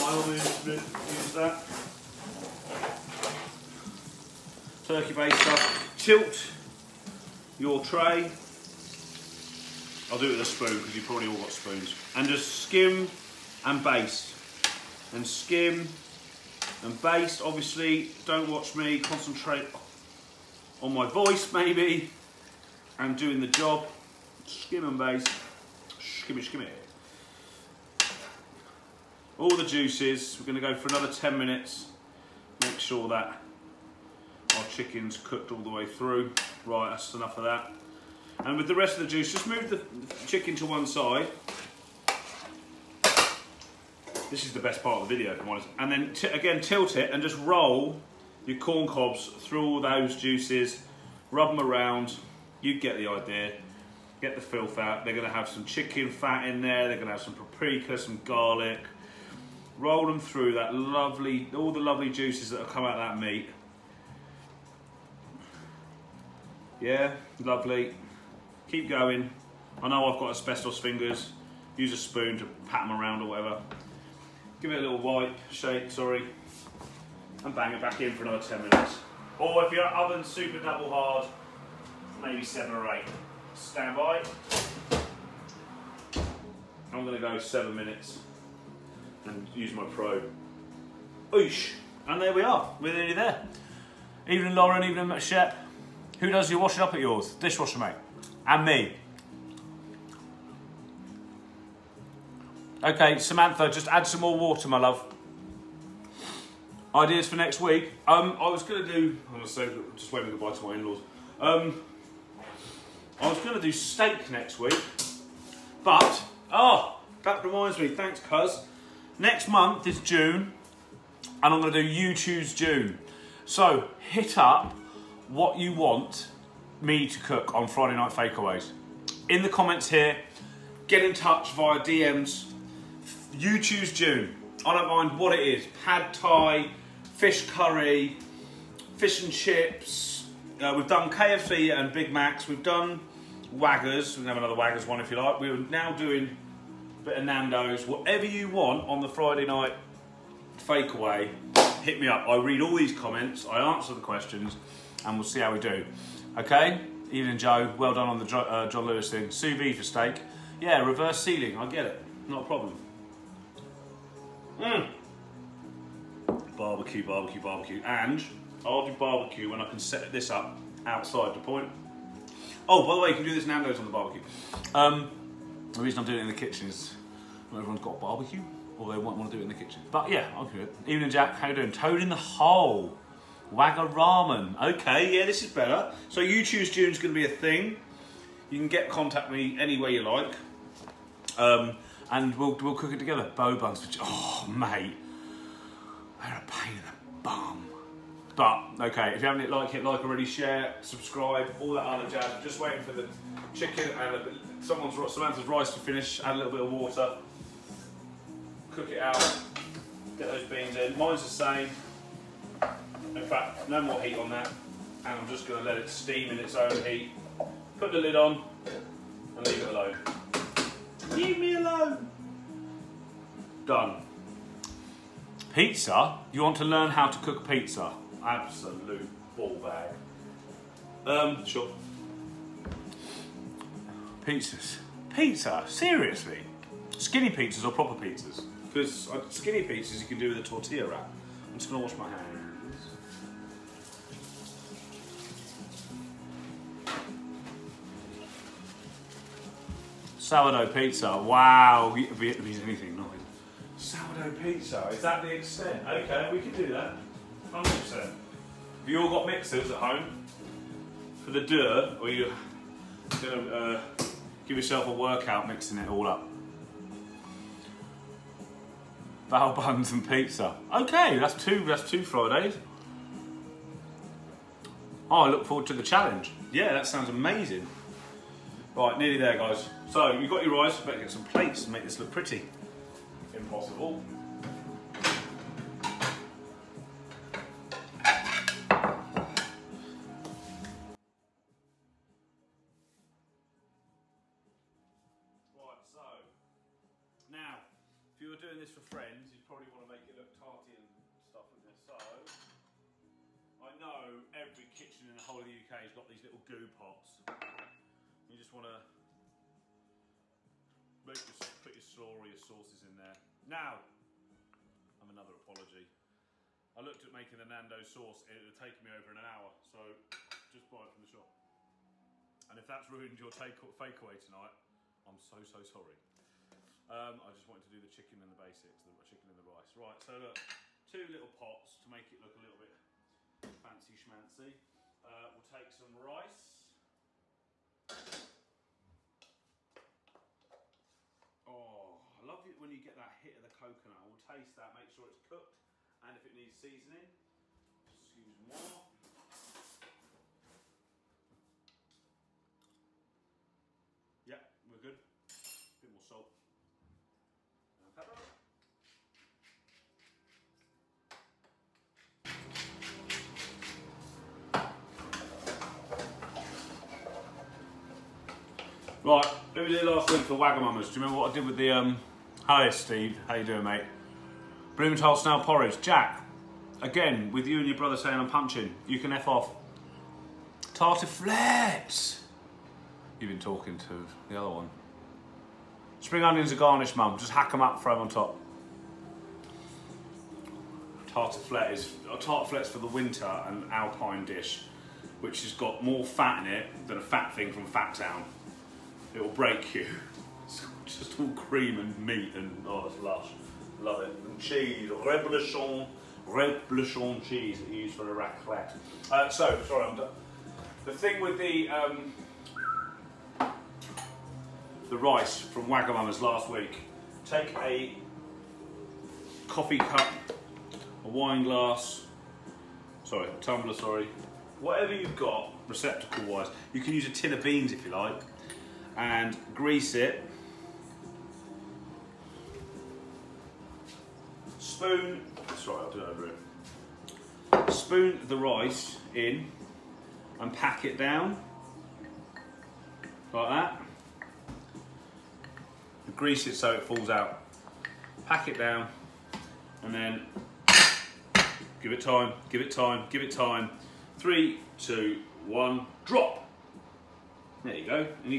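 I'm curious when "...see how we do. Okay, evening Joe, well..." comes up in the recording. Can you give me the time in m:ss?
2:35.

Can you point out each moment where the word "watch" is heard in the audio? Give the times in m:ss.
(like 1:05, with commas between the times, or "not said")
0:18.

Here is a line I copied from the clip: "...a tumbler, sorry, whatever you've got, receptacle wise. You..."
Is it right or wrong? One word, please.
right.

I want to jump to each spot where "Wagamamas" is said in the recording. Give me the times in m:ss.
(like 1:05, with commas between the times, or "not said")
6:10, 6:55.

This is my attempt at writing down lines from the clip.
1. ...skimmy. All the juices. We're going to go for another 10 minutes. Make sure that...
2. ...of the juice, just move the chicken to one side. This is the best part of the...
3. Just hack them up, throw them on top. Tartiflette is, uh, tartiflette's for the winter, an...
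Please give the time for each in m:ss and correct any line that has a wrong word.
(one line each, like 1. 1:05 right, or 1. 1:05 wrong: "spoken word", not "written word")
1. 0:26 right
2. 0:38 right
3. 6:27 right.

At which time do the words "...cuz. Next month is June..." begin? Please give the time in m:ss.
1:58.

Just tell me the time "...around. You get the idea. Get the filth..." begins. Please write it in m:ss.
0:51.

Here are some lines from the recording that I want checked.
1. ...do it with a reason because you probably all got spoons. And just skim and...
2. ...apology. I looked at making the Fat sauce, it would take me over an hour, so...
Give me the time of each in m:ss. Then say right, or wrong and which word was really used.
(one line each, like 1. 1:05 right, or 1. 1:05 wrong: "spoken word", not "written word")
1. 0:10 wrong: "spoon", not "reason"
2. 5:15 wrong: "Nando", not "Fat".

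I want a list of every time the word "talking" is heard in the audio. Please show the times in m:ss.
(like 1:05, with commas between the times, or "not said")
6:23.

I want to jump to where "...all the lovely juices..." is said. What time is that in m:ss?
1:01.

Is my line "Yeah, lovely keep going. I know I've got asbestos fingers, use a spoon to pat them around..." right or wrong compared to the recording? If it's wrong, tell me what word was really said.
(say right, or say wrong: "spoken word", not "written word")
right.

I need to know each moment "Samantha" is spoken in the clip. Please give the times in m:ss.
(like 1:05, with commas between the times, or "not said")
1:43, 3:25.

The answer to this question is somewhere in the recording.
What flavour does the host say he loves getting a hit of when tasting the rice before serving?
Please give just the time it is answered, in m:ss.
5:43.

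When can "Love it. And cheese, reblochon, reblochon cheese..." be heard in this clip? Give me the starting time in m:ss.
6:43.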